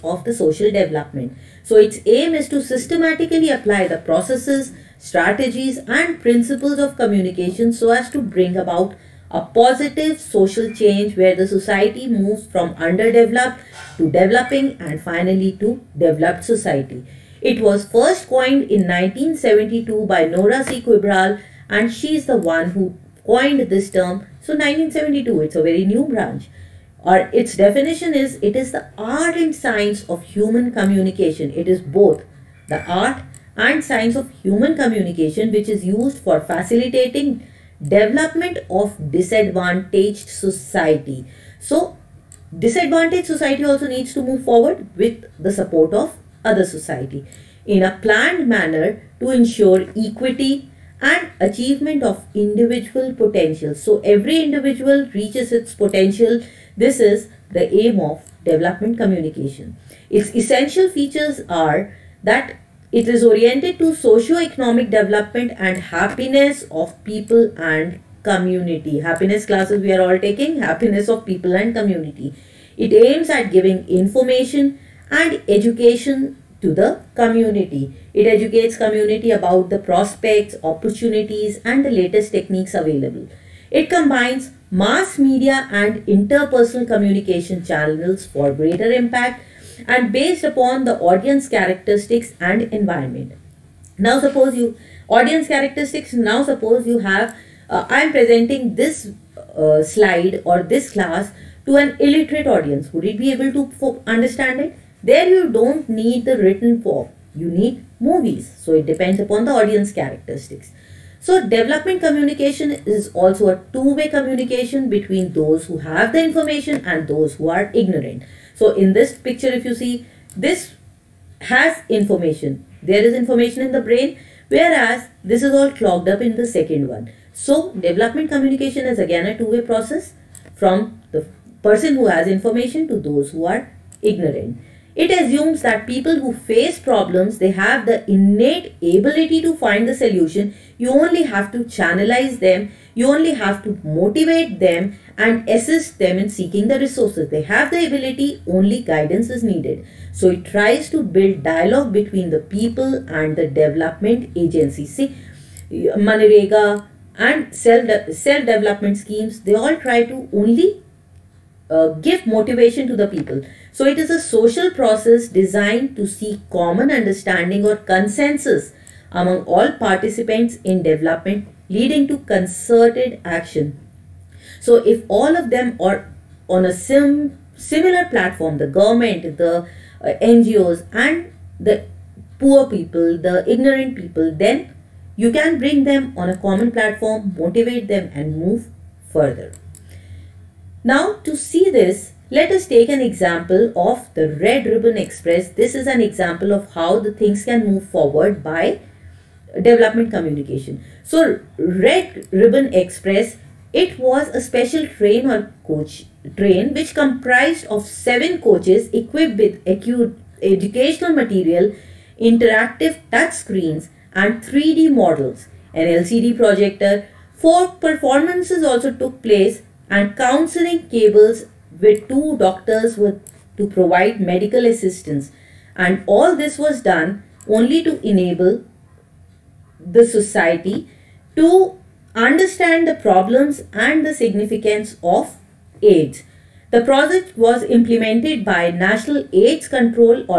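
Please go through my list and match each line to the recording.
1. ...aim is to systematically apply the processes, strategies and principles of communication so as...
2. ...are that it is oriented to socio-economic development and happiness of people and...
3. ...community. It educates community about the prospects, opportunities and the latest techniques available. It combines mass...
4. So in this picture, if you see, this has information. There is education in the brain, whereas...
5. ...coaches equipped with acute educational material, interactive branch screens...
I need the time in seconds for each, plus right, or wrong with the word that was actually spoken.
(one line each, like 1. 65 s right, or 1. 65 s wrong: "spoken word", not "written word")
1. 2 s right
2. 61 s right
3. 77 s right
4. 118 s wrong: "information", not "education"
5. 208 s wrong: "touch", not "branch".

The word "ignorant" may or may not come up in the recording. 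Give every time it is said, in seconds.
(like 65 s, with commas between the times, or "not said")
117 s, 134 s, 183 s.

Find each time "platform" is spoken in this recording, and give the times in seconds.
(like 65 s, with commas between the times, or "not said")
178 s, 186 s.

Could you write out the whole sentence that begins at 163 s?
So it is a social process designed to seek common understanding or consensus among all participants in development leading to concerted action.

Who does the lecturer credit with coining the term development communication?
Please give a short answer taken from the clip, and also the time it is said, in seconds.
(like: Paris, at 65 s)
Nora C. Quebral, at 20 s.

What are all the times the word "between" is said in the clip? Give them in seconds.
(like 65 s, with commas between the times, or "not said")
114 s, 151 s.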